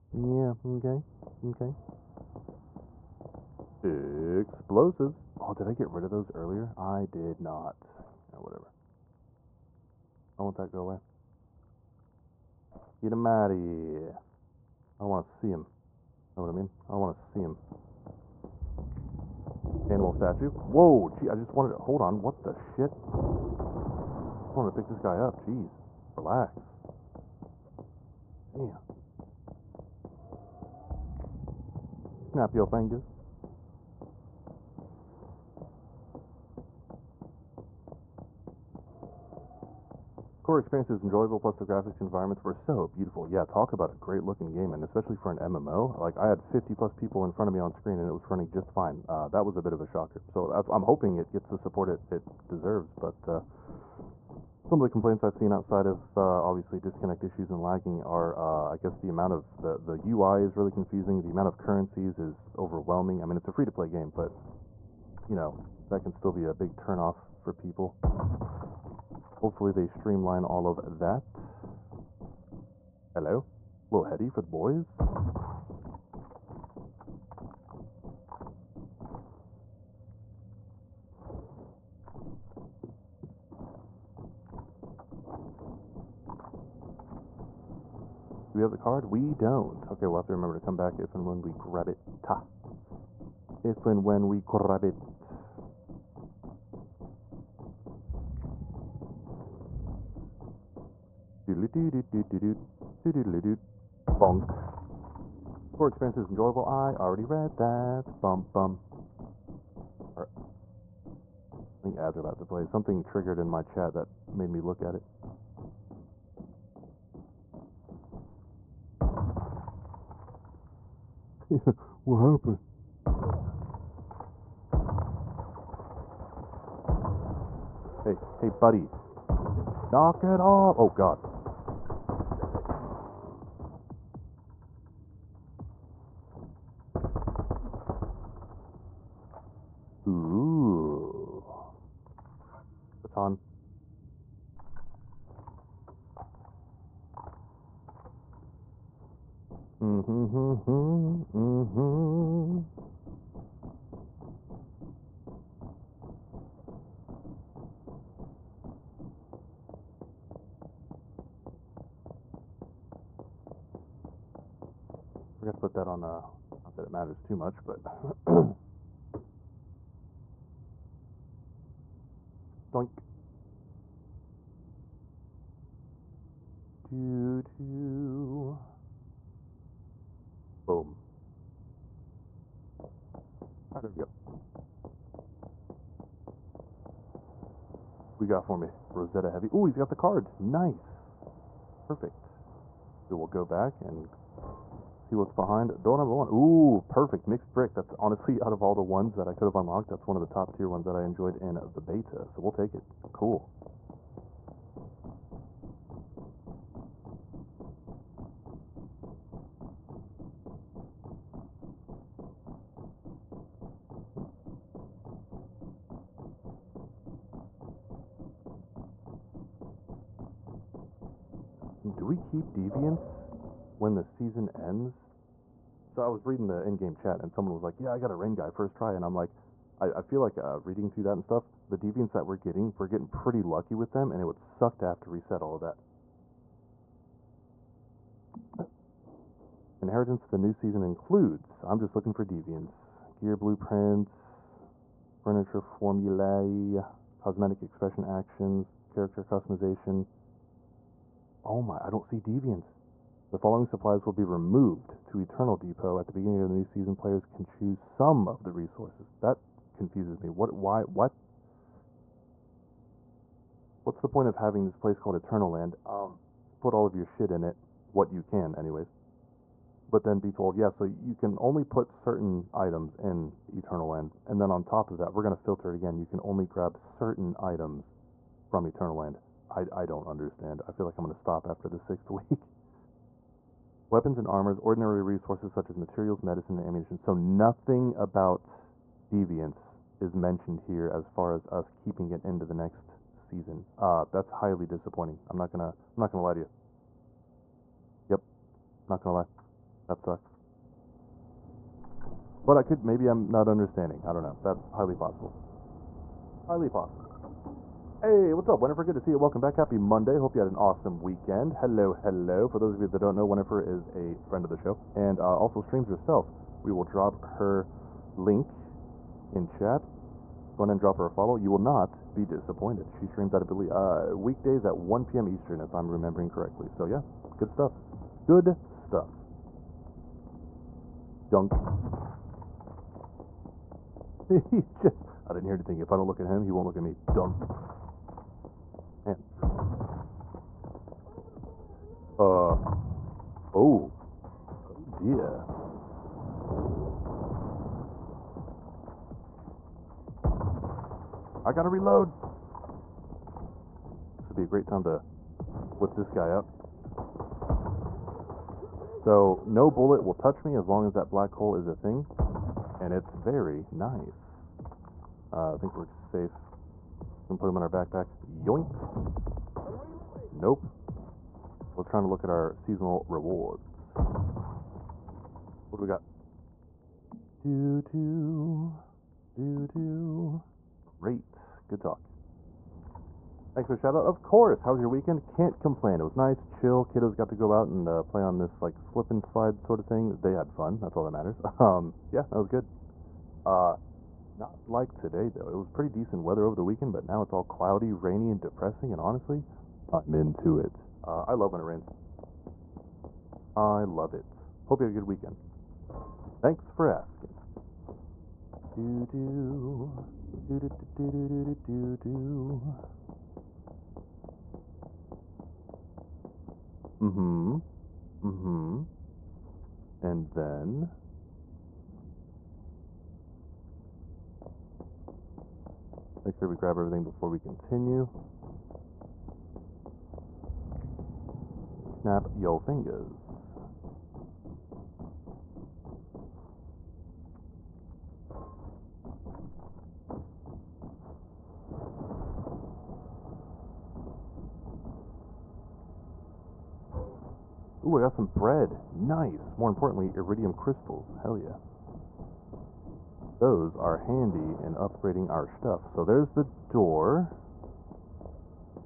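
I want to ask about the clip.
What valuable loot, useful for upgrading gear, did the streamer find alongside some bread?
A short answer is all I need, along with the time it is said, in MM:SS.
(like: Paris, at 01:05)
iridium crystals, at 07:30.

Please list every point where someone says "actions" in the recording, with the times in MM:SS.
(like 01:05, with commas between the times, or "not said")
04:08.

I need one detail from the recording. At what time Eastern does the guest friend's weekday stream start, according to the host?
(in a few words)
1 p.m.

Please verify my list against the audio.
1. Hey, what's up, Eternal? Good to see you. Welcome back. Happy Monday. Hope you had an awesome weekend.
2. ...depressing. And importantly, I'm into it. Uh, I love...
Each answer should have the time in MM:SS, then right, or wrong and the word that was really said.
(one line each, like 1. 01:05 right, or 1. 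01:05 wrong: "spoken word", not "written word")
1. 05:08 wrong: "Winifred", not "Eternal"
2. 06:38 wrong: "honestly", not "importantly".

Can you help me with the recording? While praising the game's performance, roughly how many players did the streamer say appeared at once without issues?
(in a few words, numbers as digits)
50 plus.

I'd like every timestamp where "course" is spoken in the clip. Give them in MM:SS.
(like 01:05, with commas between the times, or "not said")
06:24.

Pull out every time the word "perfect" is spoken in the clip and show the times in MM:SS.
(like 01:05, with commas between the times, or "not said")
03:11, 03:16.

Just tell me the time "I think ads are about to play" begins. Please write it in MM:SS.
01:51.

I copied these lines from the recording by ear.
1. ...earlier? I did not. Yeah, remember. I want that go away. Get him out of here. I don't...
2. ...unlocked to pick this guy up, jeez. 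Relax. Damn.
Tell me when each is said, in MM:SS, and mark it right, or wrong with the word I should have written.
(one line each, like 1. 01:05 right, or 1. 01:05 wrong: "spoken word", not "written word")
1. 00:06 wrong: "whatever", not "remember"
2. 00:24 wrong: "wanted", not "unlocked".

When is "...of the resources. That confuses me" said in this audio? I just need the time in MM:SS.
04:18.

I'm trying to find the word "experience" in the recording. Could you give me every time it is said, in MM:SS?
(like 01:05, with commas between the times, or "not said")
00:40, 01:45.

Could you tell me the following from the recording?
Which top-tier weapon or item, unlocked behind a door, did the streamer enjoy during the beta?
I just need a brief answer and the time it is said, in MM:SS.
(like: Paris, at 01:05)
Mixed brick, at 03:17.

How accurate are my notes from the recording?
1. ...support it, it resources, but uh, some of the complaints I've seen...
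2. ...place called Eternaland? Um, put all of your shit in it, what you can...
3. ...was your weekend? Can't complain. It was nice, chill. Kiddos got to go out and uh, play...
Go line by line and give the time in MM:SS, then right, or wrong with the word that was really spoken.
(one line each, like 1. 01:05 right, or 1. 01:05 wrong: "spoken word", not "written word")
1. 00:51 wrong: "deserves", not "resources"
2. 04:24 right
3. 06:24 right.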